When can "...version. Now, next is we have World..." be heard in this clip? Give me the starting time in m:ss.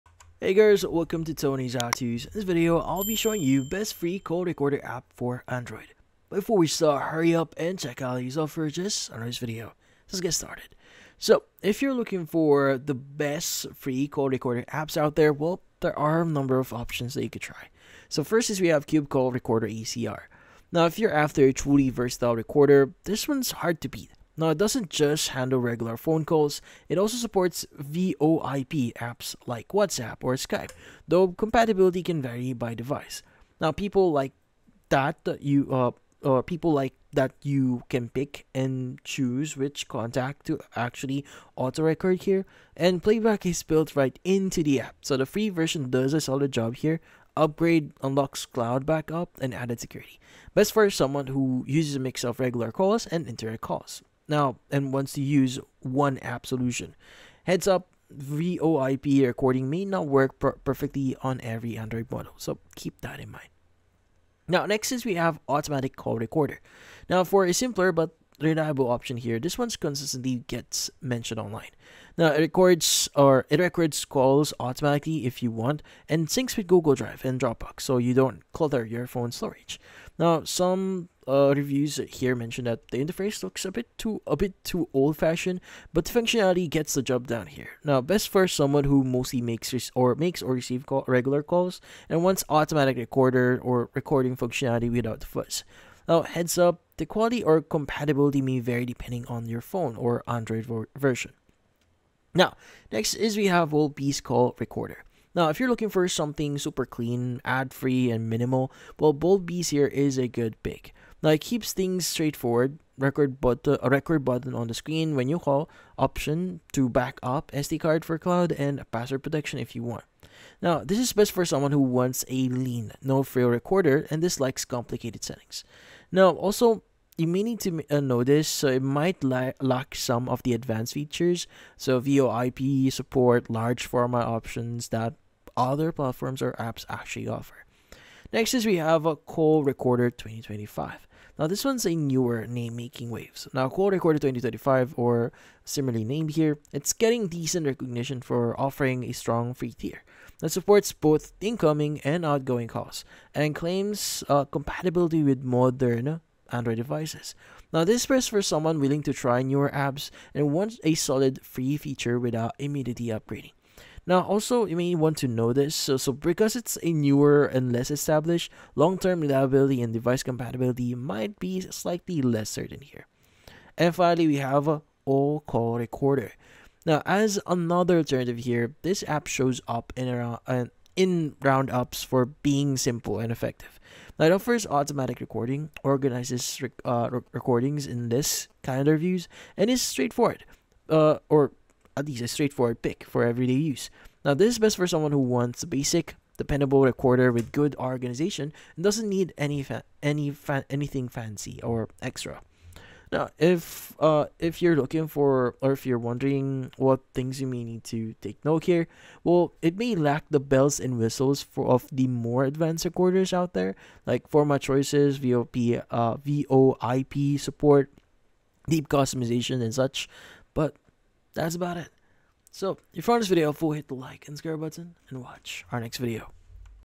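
1:40.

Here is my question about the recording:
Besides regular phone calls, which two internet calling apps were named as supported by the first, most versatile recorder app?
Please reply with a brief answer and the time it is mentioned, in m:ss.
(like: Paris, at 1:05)
WhatsApp or Skype, at 0:29.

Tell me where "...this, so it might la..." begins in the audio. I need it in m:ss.
2:08.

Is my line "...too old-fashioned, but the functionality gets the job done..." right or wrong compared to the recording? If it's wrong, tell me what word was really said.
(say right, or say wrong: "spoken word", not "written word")
right.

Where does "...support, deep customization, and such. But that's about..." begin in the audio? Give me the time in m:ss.
3:37.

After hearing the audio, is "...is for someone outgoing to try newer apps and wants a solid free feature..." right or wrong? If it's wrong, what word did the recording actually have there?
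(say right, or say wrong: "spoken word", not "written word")
wrong: "willing", not "outgoing".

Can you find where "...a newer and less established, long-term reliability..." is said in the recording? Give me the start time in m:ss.
2:46.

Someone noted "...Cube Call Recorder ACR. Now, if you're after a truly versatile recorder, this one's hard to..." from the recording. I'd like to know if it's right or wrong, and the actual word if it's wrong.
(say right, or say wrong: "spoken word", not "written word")
right.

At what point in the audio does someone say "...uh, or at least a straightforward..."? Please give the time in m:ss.
3:10.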